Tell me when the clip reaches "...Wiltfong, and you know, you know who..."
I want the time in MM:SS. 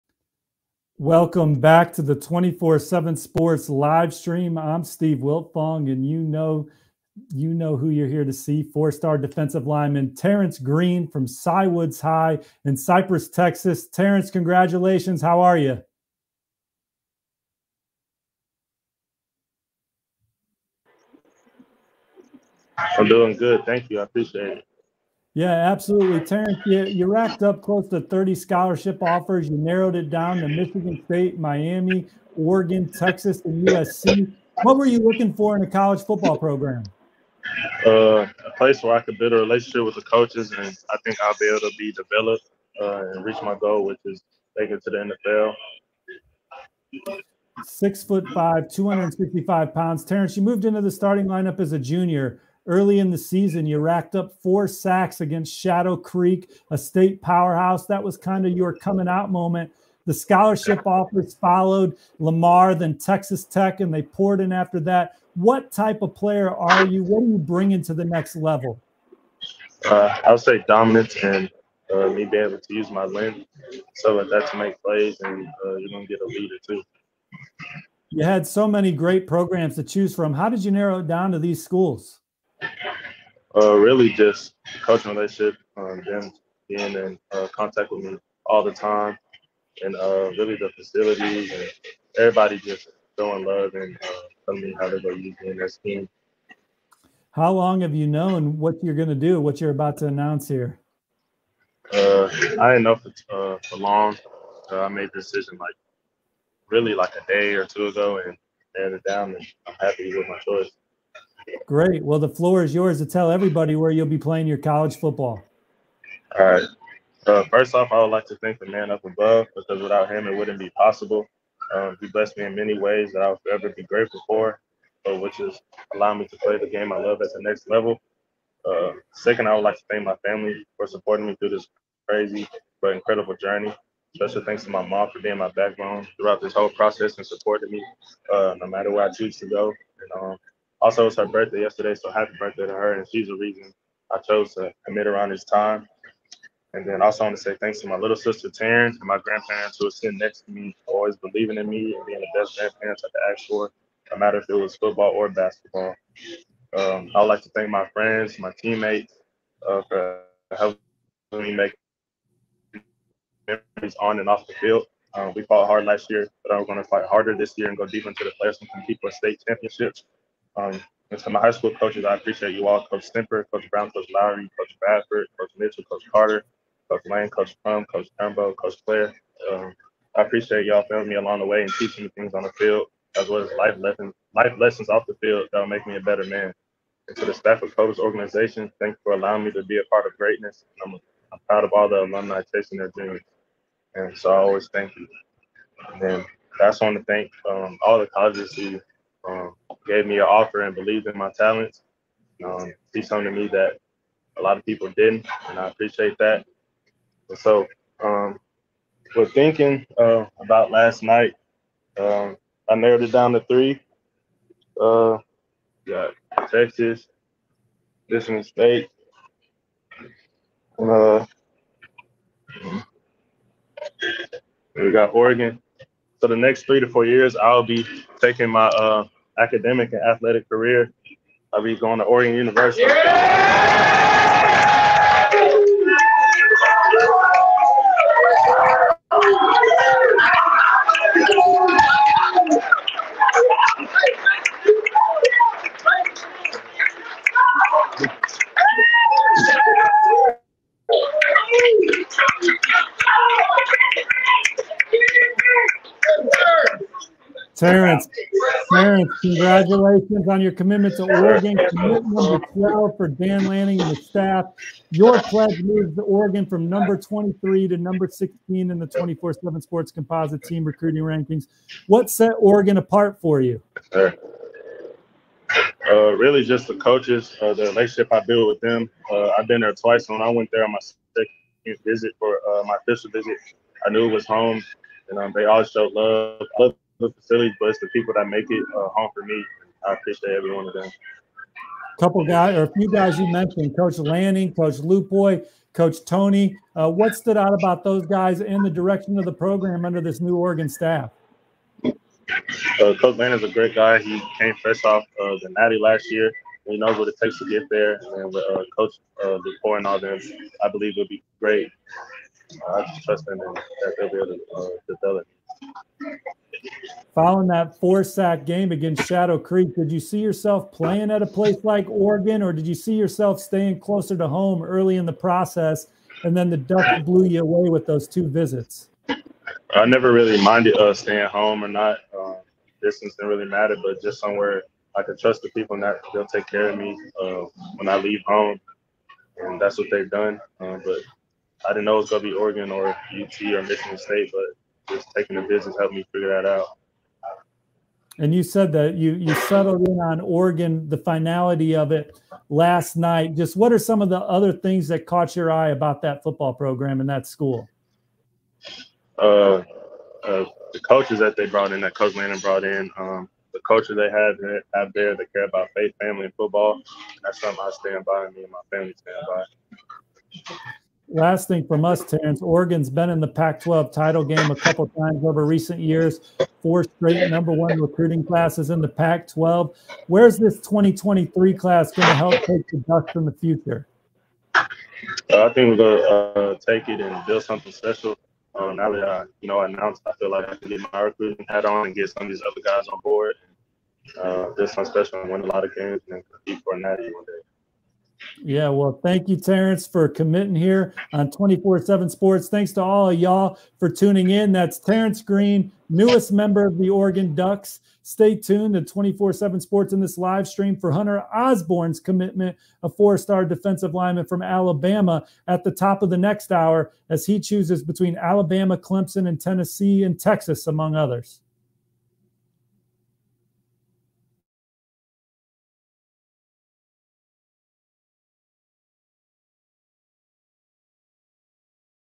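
00:05.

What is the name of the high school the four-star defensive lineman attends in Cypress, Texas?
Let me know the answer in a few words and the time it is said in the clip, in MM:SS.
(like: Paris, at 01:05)
Cywoods High, at 00:11.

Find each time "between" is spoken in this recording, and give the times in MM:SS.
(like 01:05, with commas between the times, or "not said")
06:57.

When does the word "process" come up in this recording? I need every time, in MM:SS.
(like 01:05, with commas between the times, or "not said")
02:16, 05:25.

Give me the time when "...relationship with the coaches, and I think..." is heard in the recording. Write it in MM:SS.
00:39.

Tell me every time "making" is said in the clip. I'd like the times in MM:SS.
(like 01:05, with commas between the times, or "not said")
00:44.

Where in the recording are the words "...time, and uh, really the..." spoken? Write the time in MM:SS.
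01:28.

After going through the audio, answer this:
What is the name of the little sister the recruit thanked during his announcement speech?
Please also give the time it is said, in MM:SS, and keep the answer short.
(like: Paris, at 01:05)
Taryn, at 02:28.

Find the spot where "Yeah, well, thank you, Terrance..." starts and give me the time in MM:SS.
06:38.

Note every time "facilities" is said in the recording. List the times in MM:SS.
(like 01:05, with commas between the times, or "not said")
01:30, 04:47.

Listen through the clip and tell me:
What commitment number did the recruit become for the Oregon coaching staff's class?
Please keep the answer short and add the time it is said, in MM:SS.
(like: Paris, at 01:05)
12, at 04:21.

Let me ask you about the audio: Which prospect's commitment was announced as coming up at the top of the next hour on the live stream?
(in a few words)
Hunter Osborne.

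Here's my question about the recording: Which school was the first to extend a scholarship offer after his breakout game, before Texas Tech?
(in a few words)
Lamar.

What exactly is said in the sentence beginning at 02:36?
Um, I would like to thank my friends, my teammates, uh, for helping me make memories on and off the field.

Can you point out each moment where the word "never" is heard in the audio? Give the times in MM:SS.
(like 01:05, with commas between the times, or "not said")
05:29.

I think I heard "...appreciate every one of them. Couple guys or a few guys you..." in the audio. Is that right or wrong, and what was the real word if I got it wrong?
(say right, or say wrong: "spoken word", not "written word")
right.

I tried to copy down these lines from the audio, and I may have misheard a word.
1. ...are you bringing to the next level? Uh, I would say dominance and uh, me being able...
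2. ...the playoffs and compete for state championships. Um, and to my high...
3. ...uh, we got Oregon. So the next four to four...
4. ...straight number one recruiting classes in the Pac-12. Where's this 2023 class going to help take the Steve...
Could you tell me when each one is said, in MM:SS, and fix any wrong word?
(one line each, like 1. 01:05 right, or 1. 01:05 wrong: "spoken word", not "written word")
1. 01:07 right
2. 02:48 right
3. 03:40 wrong: "three", not "four"
4. 06:16 wrong: "Ducks", not "Steve".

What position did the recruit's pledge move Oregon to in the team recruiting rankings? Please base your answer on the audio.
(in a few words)
16.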